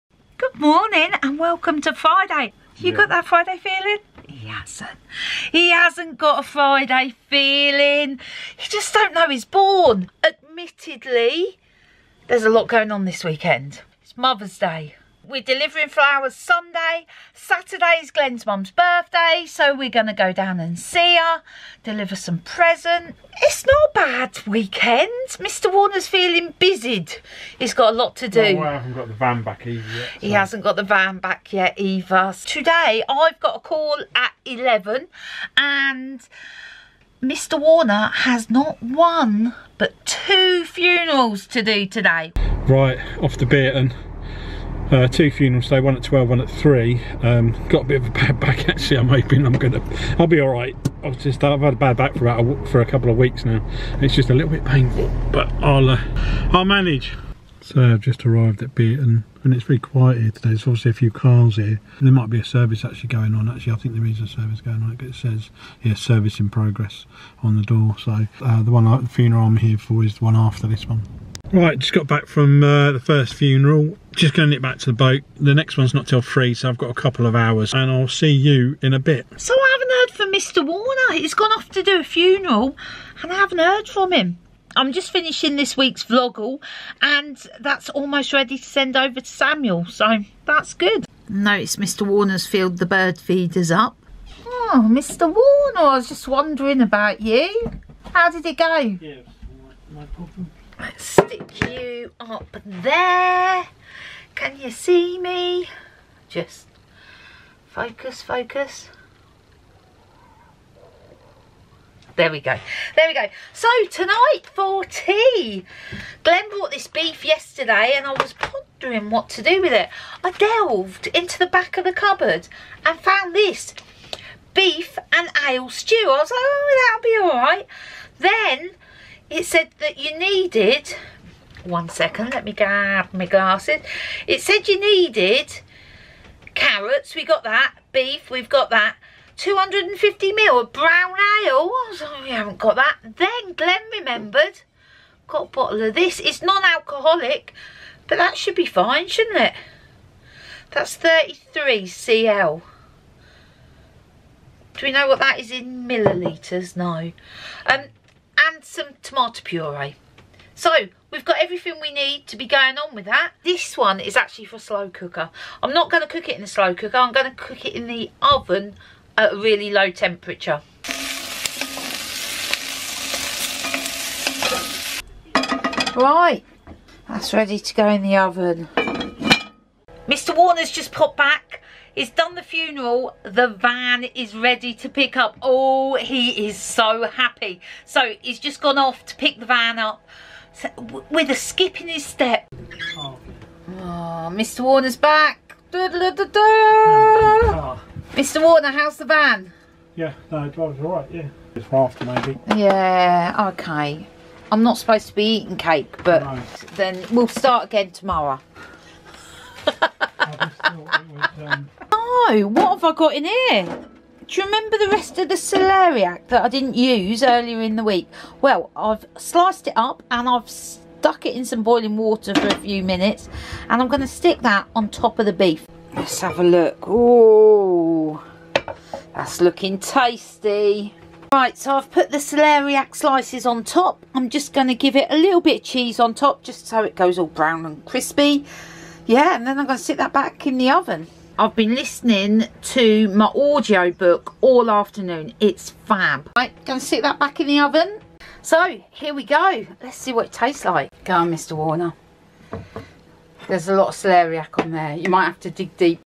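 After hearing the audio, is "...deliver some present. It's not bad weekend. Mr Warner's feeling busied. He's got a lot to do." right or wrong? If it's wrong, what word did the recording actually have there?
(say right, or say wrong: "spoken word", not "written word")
right.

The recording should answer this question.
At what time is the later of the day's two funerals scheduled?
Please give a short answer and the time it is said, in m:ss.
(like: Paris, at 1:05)
3, at 0:46.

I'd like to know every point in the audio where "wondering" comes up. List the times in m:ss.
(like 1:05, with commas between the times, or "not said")
1:36.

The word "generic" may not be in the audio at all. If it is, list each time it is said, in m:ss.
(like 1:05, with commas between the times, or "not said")
not said.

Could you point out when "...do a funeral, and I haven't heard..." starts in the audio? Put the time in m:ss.
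1:21.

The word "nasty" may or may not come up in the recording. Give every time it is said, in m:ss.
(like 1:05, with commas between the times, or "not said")
not said.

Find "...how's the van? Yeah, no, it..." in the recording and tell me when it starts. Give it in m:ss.
3:18.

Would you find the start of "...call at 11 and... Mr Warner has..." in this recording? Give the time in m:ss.
0:33.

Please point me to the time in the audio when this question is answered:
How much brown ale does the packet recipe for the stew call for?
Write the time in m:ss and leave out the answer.
2:19.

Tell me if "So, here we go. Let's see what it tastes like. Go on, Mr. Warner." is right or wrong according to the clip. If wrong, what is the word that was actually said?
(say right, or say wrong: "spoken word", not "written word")
right.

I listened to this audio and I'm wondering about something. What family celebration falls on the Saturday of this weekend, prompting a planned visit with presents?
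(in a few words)
Glenn's mum's birthday.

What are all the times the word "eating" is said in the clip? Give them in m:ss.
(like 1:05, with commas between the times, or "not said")
3:25.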